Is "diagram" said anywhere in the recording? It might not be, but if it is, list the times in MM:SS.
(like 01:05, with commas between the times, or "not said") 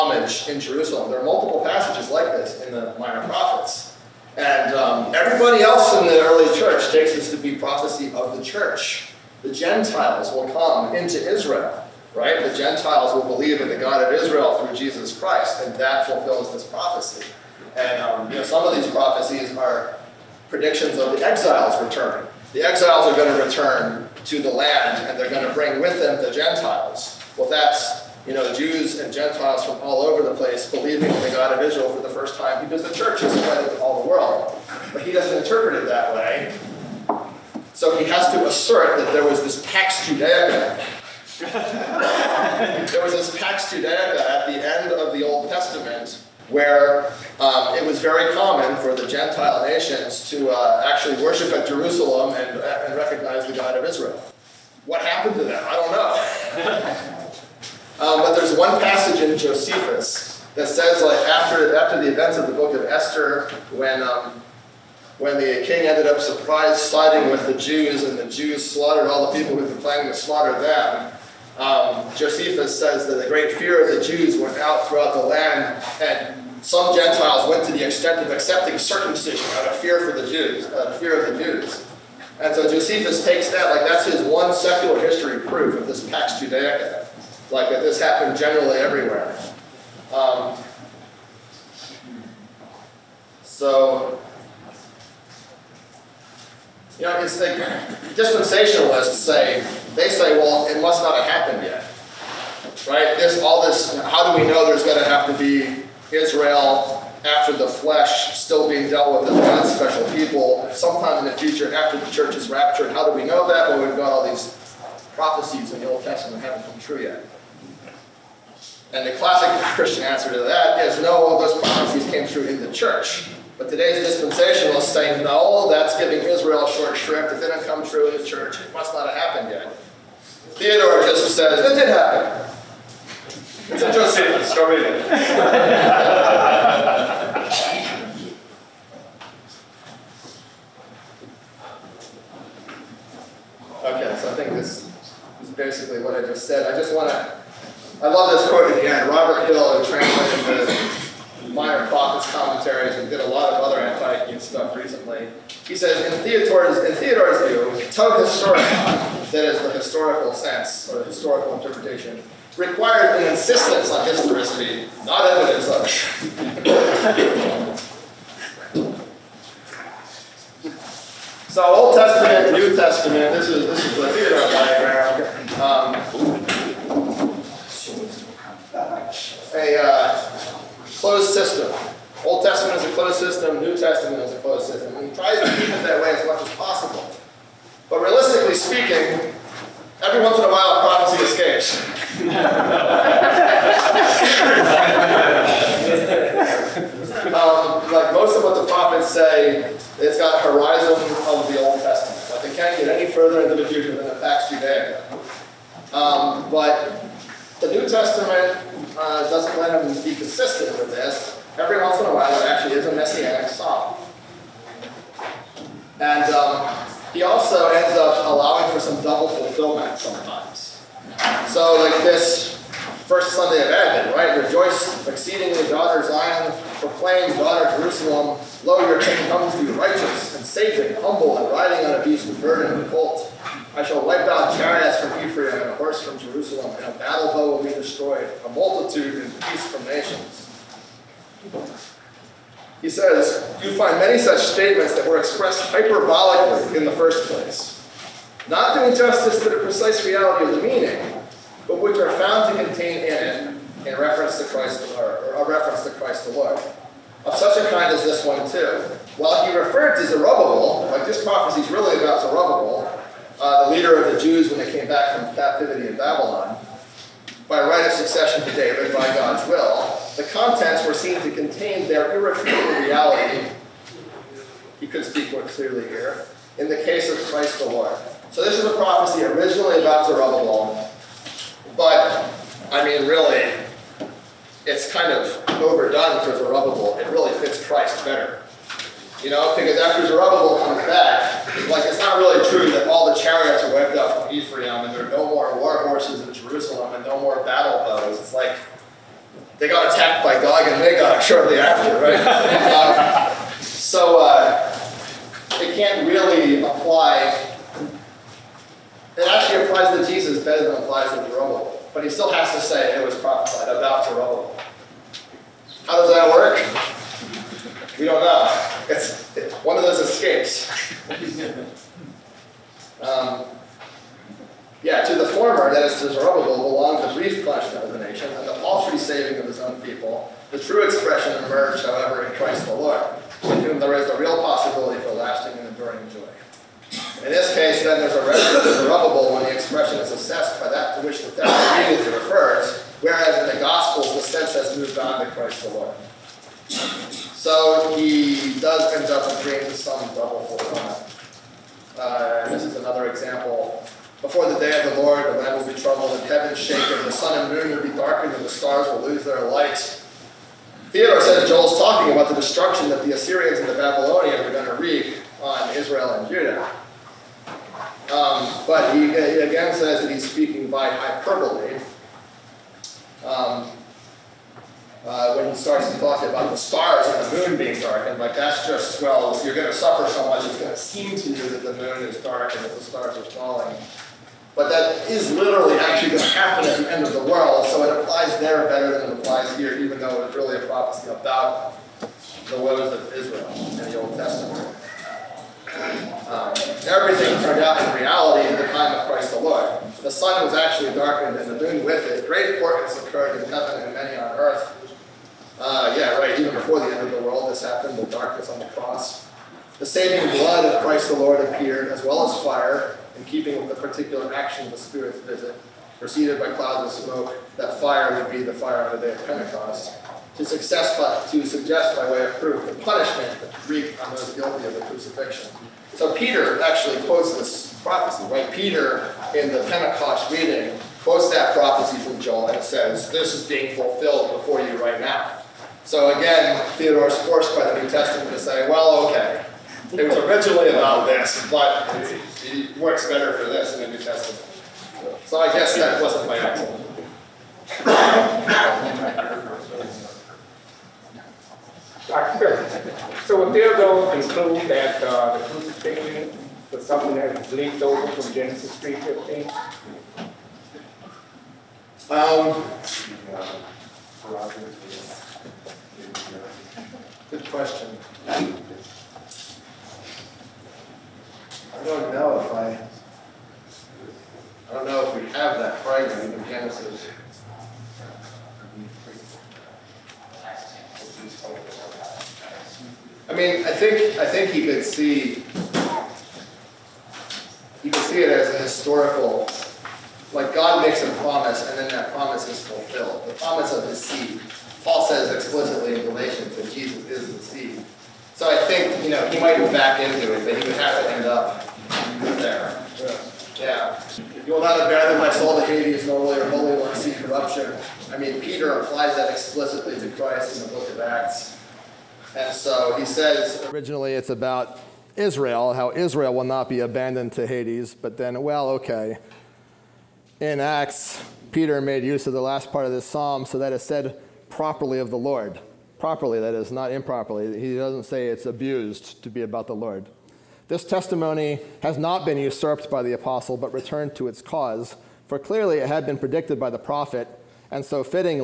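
02:54.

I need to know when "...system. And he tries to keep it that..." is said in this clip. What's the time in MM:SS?
03:04.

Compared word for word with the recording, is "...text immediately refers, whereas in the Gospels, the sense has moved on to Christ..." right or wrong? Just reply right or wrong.
right.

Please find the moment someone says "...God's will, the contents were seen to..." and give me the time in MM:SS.
04:29.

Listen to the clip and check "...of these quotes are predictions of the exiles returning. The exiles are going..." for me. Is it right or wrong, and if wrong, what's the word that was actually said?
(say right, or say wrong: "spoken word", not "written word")
wrong: "prophecies", not "quotes".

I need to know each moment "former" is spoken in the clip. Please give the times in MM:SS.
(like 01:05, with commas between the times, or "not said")
05:25.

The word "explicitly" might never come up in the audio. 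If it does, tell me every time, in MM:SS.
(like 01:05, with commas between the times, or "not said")
08:15, 08:29.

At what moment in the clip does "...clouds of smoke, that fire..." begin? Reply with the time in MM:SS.
06:56.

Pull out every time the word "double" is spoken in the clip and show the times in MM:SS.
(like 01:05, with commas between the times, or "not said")
03:39, 05:50.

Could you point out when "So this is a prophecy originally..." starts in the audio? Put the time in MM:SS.
04:38.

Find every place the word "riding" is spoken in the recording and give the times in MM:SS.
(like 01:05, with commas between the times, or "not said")
03:51.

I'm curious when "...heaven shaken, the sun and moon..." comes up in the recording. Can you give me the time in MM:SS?
05:56.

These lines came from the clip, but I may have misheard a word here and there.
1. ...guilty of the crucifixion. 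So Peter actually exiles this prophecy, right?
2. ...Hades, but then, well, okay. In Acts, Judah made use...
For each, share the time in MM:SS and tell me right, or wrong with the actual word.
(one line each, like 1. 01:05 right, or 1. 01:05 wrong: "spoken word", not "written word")
1. 07:04 wrong: "quotes", not "exiles"
2. 08:37 wrong: "Peter", not "Judah".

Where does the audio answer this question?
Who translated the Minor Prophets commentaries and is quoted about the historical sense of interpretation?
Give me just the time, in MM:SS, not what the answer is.
02:29.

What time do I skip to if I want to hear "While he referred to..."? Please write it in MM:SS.
04:19.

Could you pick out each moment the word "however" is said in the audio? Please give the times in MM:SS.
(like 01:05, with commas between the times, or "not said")
05:31.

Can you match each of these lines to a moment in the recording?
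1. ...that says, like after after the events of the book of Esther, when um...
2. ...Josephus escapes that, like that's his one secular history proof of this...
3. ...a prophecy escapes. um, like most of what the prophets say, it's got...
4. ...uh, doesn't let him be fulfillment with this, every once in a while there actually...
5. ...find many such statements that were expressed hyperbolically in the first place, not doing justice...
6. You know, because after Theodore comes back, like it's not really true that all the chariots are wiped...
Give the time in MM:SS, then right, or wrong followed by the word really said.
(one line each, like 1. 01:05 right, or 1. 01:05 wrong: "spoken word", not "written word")
1. 01:00 right
2. 01:22 wrong: "takes", not "escapes"
3. 03:10 right
4. 03:28 wrong: "consistent", not "fulfillment"
5. 04:03 right
6. 04:49 wrong: "Zerubbabel", not "Theodore".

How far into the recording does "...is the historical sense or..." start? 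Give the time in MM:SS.
02:39.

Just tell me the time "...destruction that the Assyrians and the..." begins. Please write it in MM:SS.
06:02.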